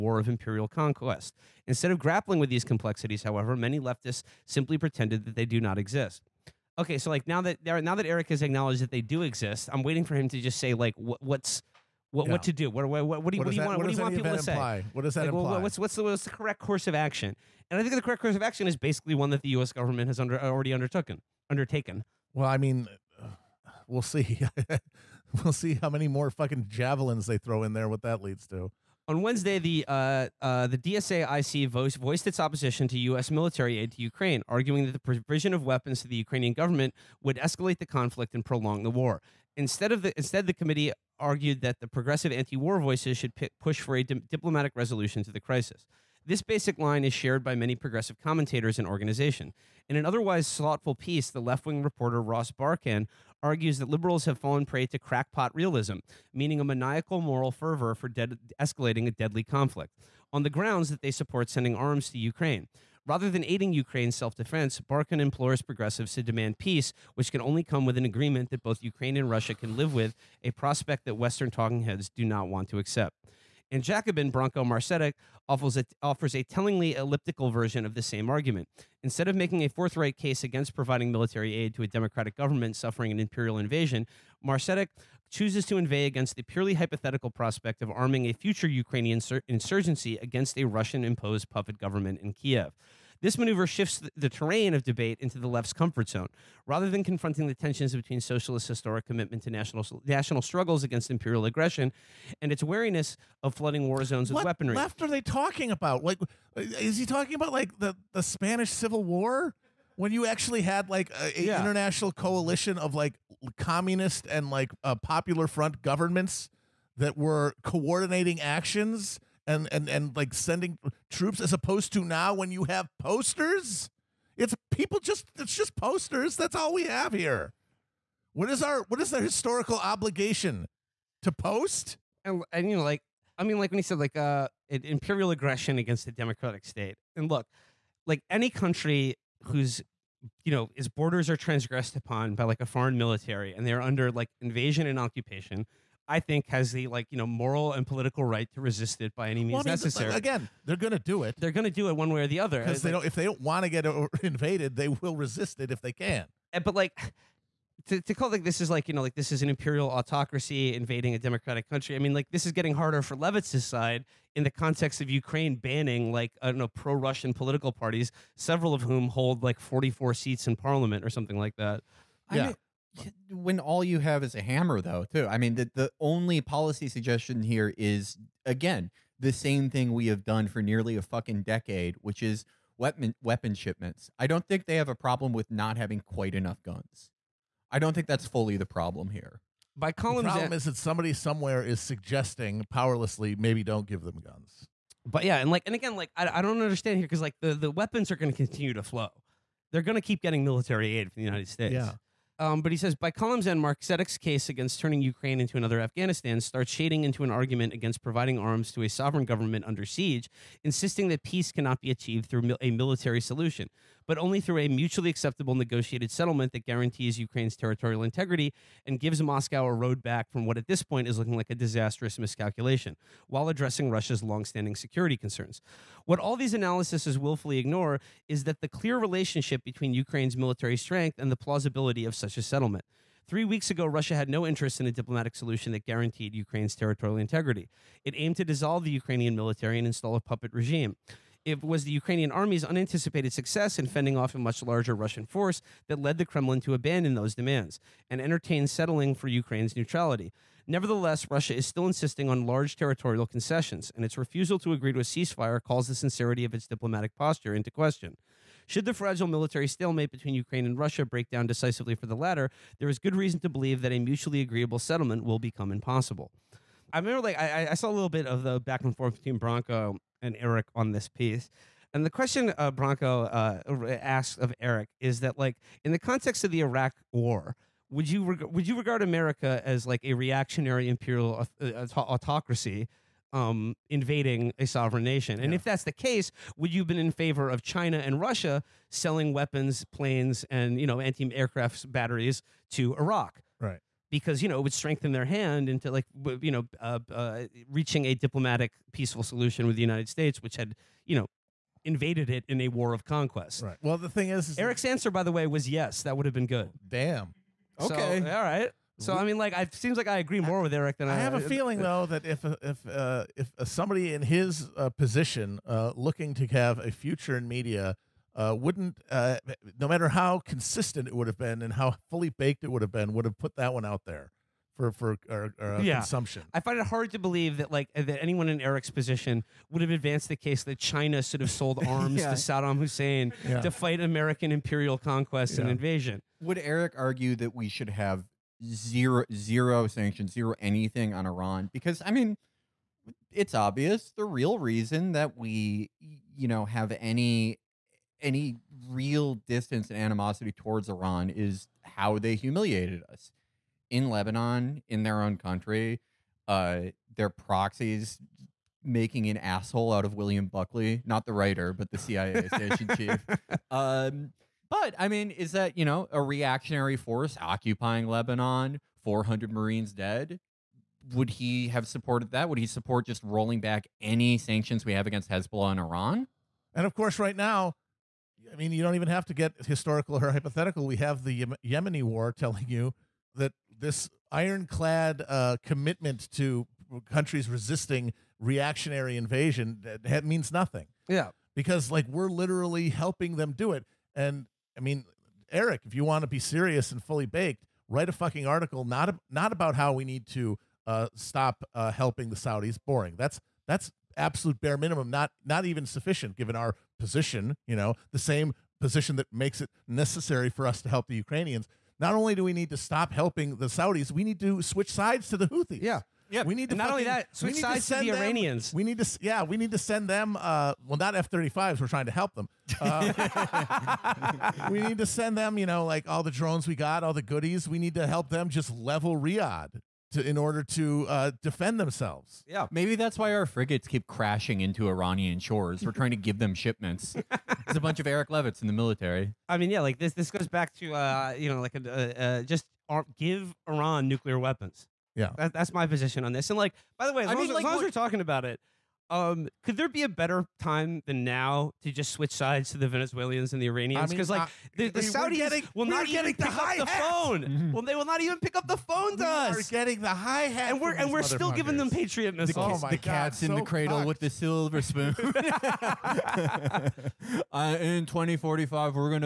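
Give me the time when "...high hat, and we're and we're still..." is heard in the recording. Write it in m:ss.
7:40.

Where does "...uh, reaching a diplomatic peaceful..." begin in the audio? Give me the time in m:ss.
4:57.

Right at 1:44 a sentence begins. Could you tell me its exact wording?
What left are they talking about?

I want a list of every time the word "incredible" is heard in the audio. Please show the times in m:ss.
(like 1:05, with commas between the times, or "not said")
not said.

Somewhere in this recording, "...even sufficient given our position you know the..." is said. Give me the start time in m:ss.
6:45.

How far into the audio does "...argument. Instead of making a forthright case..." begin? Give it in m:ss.
1:18.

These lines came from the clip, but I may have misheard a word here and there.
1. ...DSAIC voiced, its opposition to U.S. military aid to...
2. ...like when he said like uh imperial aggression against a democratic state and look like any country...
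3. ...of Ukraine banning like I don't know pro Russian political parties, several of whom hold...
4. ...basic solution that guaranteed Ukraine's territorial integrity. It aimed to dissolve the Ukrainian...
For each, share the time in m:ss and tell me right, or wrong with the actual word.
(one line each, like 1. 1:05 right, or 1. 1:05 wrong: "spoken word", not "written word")
1. 0:30 right
2. 2:13 right
3. 2:45 right
4. 3:54 wrong: "diplomatic", not "basic".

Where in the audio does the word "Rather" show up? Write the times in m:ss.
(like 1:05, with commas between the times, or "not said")
1:03, 1:36.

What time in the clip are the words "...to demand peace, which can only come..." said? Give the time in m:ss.
1:06.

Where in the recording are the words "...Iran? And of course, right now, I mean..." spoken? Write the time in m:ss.
6:15.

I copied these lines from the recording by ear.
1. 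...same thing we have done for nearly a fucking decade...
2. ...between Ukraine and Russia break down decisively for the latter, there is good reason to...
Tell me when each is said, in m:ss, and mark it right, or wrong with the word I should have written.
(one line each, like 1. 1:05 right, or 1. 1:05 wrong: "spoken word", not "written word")
1. 2:59 right
2. 4:20 right.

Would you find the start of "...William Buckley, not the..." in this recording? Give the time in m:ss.
6:00.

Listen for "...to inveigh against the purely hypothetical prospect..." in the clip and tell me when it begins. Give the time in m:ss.
1:25.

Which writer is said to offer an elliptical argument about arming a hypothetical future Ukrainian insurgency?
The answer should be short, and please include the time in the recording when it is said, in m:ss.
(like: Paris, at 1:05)
Branko Marcetic, at 1:14.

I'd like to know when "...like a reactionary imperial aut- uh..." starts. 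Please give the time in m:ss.
4:39.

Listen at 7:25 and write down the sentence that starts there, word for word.
Yeah, that, that's my position on this.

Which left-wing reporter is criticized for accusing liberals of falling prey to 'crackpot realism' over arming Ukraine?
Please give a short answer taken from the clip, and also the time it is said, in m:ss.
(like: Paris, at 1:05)
Ross Barkan, at 0:52.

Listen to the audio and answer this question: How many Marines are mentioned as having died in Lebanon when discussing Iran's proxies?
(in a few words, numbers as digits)
400.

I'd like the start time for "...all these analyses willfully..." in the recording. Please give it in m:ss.
3:46.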